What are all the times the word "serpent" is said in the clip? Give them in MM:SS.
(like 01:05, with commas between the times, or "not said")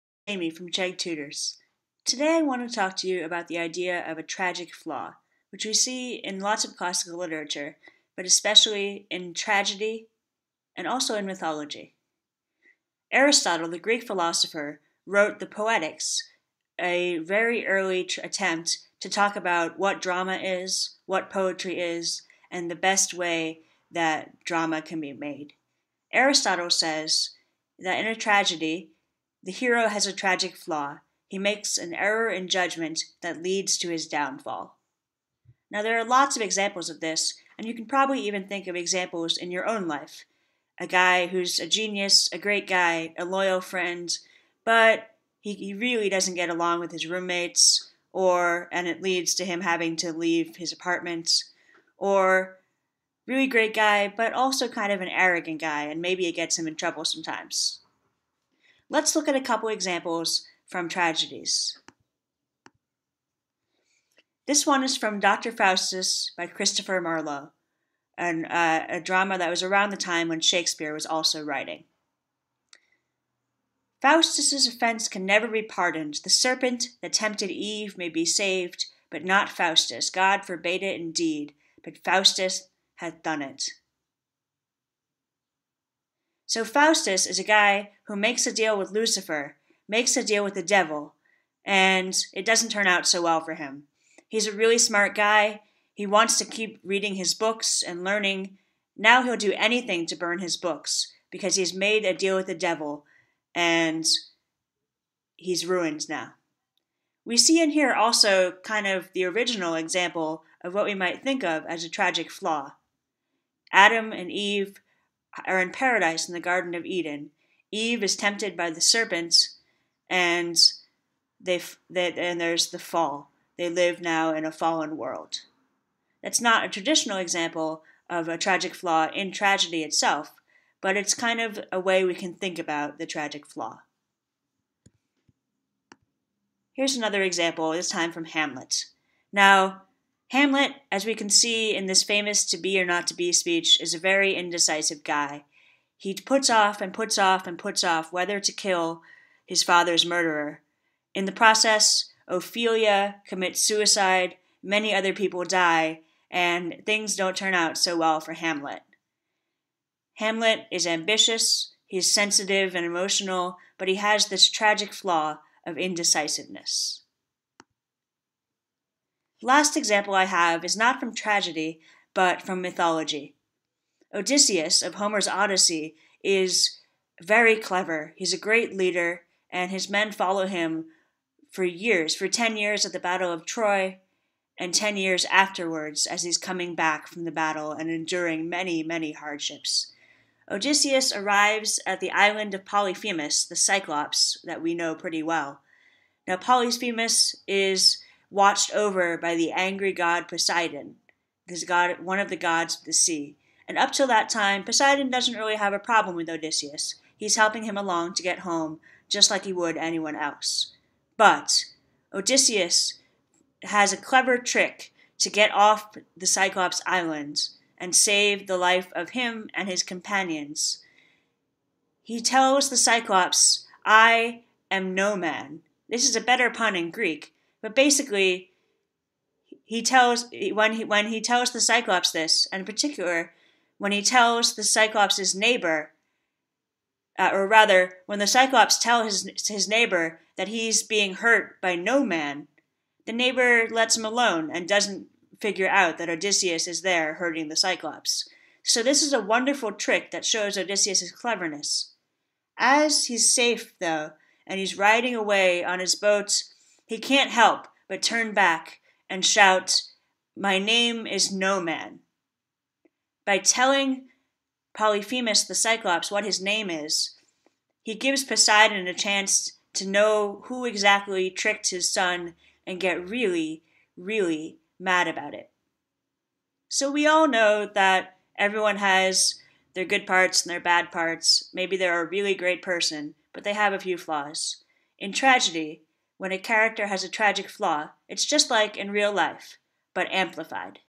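01:16, 01:58.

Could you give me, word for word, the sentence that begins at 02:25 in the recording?
He puts off and puts off and puts off whether to kill his father's murderer.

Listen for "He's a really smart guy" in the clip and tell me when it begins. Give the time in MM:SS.
01:34.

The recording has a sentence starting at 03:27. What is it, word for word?
He's helping him along to get home, just like he would anyone else.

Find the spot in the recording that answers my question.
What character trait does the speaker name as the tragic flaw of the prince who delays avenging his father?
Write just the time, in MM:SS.
02:45.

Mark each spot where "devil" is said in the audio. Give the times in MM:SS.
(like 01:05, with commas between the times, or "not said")
01:30, 01:42.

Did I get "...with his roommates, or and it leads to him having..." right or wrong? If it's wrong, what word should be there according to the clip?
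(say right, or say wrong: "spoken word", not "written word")
right.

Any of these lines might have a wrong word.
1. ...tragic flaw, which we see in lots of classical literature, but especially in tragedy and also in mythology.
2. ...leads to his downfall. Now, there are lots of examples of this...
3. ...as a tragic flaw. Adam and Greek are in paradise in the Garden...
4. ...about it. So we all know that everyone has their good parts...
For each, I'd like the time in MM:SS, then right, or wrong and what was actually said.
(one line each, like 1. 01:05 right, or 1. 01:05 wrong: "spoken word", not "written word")
1. 00:04 right
2. 00:33 right
3. 01:51 wrong: "Eve", not "Greek"
4. 04:35 right.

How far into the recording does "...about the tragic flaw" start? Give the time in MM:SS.
02:12.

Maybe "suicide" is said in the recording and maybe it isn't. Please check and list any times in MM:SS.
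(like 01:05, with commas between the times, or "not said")
02:33.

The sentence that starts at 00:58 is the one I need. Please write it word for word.
Let's look at a couple examples from tragedies.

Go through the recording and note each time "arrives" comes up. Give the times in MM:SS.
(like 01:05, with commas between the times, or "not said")
03:11.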